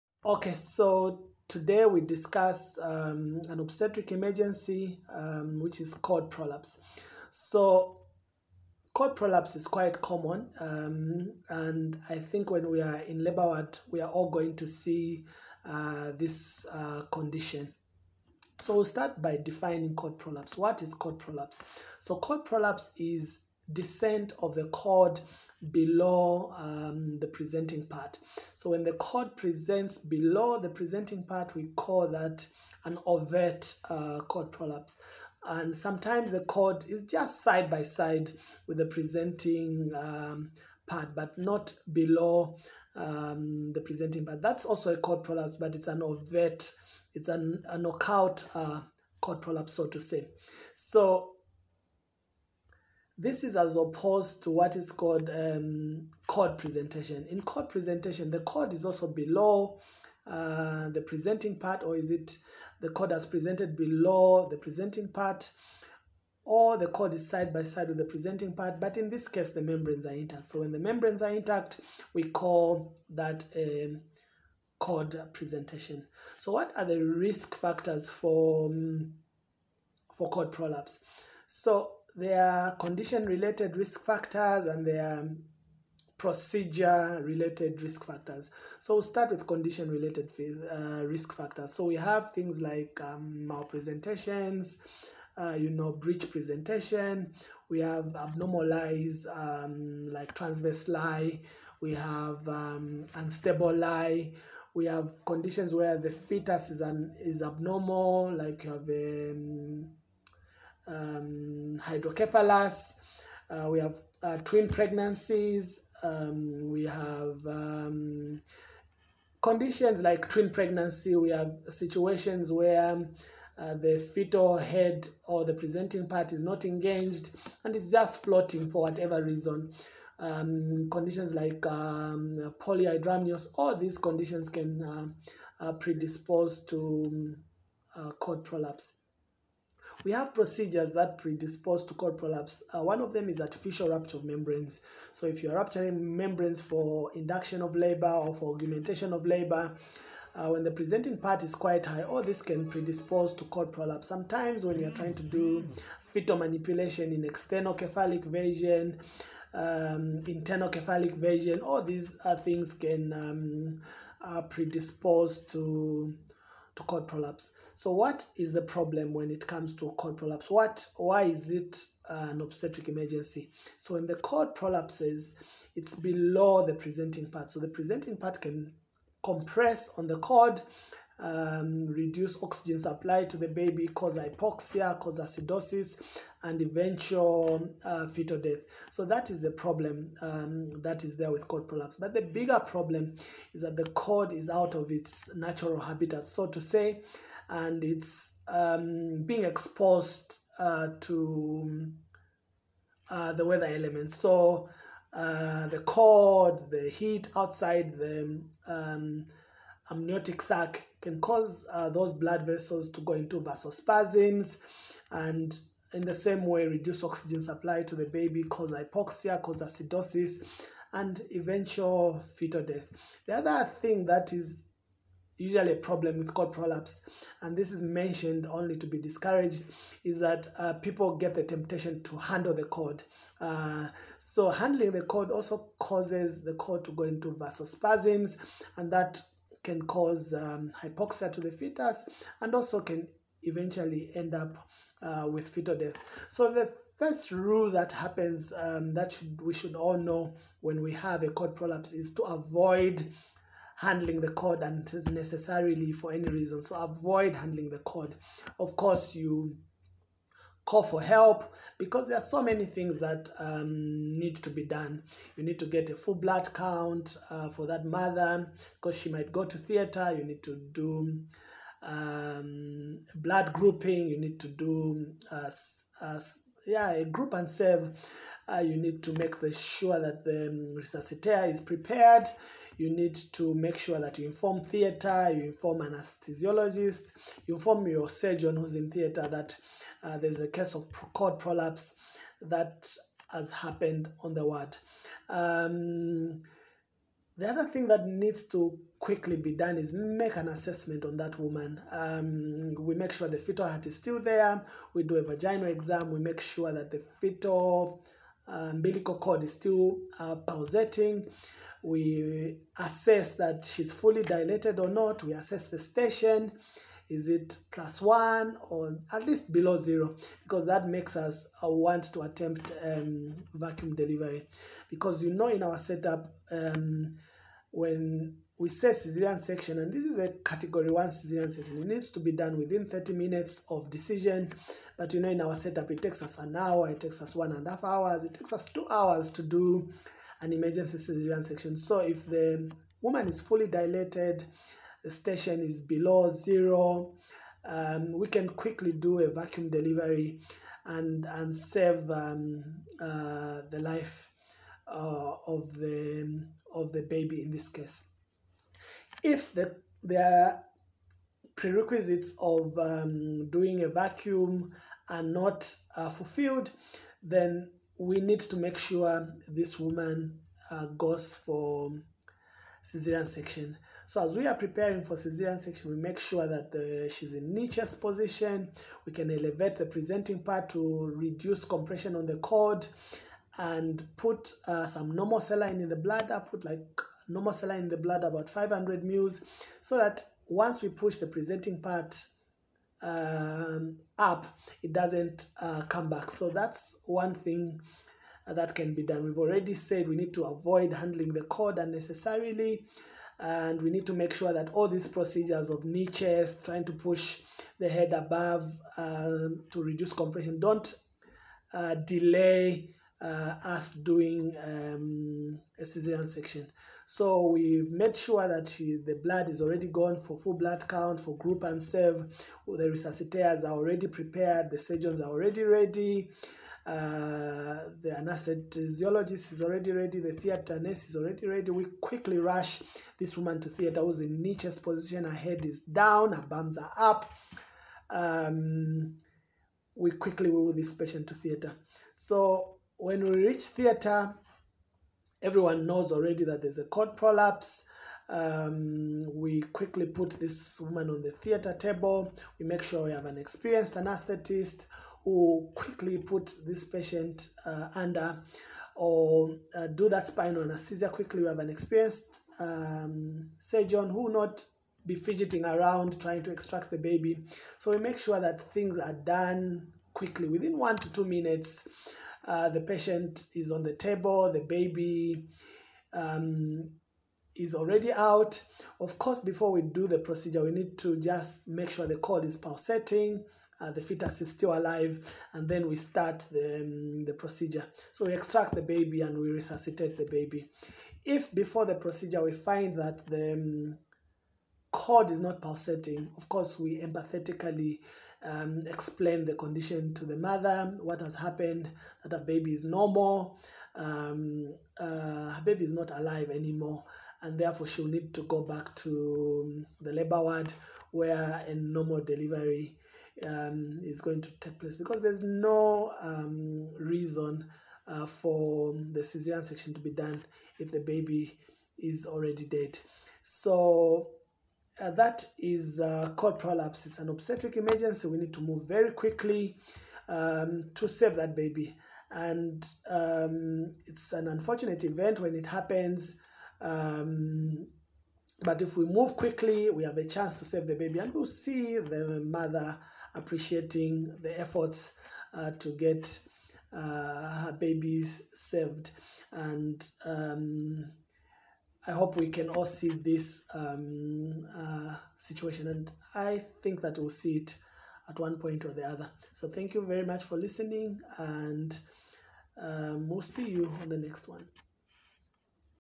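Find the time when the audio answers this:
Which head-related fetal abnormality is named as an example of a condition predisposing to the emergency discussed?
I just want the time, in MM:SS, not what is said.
01:51.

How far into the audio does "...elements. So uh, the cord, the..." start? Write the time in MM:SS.
03:23.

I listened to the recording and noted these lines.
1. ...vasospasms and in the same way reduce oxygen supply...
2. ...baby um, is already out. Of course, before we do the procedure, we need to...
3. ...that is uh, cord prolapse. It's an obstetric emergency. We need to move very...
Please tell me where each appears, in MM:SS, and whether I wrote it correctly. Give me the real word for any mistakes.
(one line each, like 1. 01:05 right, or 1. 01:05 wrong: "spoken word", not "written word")
1. 03:33 right
2. 07:54 right
3. 08:45 right.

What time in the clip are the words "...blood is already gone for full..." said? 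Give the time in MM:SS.
06:59.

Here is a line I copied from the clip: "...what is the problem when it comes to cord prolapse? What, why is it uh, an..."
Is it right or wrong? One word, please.
right.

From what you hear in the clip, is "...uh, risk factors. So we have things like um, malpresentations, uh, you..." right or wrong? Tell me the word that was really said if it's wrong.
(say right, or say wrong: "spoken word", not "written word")
right.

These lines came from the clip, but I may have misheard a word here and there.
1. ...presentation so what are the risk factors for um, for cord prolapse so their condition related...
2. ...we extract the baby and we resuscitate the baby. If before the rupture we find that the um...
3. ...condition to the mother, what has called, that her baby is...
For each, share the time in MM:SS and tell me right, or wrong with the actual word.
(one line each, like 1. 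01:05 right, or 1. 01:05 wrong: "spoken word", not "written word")
1. 01:15 right
2. 08:08 wrong: "procedure", not "rupture"
3. 08:19 wrong: "happened", not "called".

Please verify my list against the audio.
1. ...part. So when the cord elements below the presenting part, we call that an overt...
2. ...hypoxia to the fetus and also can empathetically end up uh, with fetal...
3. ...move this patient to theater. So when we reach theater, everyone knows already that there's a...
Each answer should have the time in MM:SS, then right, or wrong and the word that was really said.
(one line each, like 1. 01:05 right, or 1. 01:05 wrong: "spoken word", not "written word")
1. 00:27 wrong: "presents", not "elements"
2. 04:00 wrong: "eventually", not "empathetically"
3. 07:20 right.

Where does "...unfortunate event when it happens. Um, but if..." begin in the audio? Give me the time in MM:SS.
08:54.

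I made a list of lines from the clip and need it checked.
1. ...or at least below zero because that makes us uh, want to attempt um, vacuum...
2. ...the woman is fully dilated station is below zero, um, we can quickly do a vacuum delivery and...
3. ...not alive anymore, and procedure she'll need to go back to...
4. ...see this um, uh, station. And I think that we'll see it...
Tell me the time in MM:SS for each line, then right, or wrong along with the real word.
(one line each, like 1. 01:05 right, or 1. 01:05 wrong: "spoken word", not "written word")
1. 05:18 right
2. 05:42 right
3. 08:25 wrong: "therefore", not "procedure"
4. 09:12 wrong: "situation", not "station".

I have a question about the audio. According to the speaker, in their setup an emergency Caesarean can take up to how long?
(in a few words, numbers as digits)
two hours.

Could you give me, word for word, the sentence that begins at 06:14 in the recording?
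So as we are preparing for caesarean section, we make sure that the, uh, she's in knee-chest position.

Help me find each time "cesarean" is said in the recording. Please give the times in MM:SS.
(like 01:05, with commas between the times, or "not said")
06:55, 08:39.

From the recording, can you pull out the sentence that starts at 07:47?
So we make sure that things are done quickly within one to two minutes.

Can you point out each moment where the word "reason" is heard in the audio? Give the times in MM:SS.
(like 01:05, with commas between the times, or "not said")
02:09, 04:16, 08:36.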